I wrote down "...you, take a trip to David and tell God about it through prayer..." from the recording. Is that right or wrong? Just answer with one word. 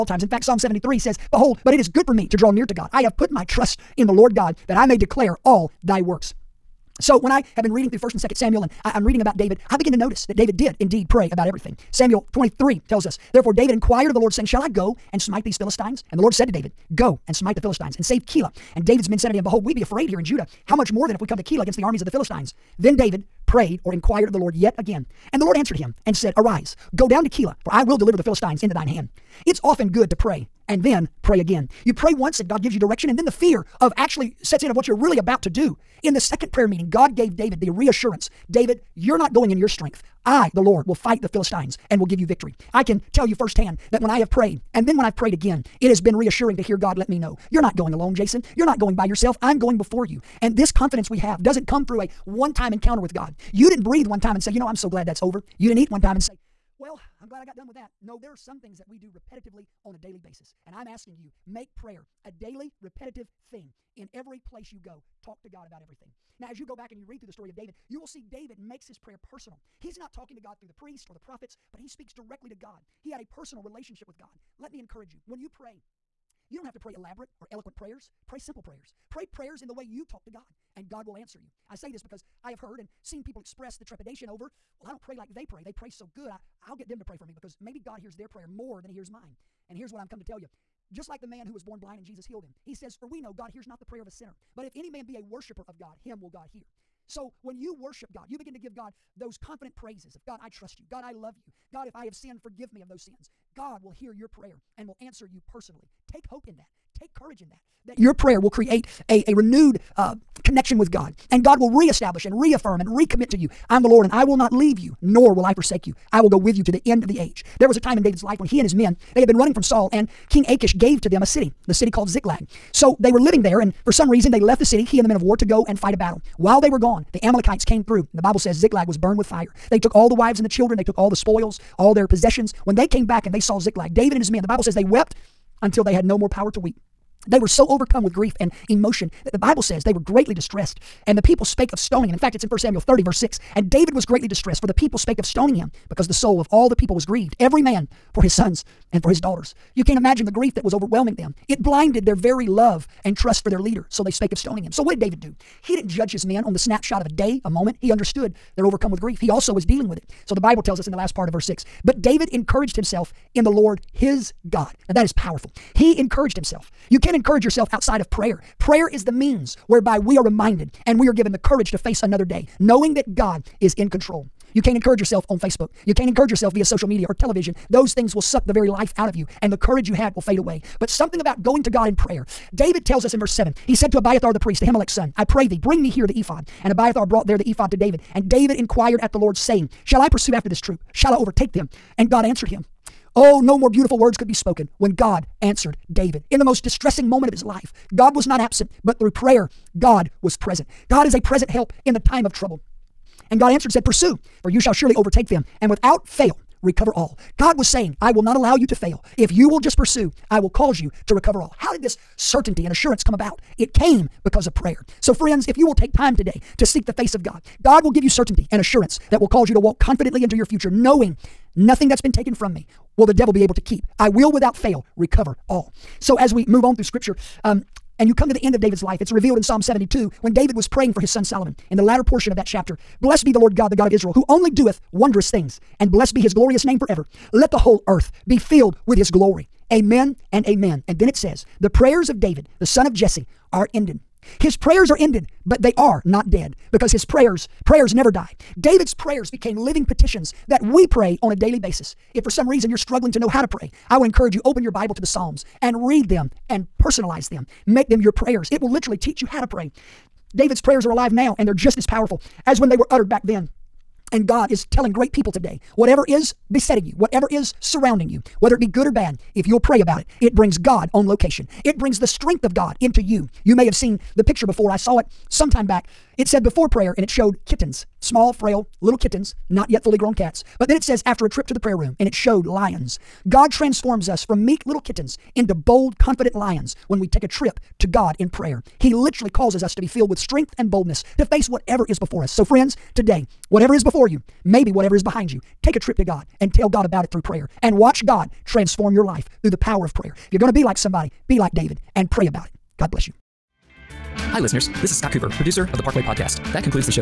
wrong.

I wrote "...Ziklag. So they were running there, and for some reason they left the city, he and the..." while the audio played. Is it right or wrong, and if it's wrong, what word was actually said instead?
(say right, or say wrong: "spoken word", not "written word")
wrong: "living", not "running".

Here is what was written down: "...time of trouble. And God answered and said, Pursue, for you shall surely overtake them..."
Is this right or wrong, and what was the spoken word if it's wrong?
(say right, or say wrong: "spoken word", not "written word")
right.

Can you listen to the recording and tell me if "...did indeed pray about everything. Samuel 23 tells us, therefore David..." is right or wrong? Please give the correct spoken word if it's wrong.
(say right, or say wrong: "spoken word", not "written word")
right.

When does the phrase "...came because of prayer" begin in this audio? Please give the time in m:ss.
3:33.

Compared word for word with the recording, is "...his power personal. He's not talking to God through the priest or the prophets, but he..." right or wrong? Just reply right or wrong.
wrong.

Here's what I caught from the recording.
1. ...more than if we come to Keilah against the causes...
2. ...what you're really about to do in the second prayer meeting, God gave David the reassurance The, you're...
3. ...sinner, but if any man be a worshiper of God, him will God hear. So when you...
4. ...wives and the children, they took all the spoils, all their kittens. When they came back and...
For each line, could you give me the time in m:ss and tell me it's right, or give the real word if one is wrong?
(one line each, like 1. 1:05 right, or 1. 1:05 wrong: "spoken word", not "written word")
1. 0:20 wrong: "armies", not "causes"
2. 0:34 wrong: "David", not "The"
3. 1:34 right
4. 2:10 wrong: "possessions", not "kittens".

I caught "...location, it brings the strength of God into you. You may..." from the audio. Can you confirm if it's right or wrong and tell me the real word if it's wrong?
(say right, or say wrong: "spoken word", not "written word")
right.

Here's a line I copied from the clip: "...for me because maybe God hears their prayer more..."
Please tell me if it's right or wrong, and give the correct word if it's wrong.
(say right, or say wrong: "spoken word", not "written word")
right.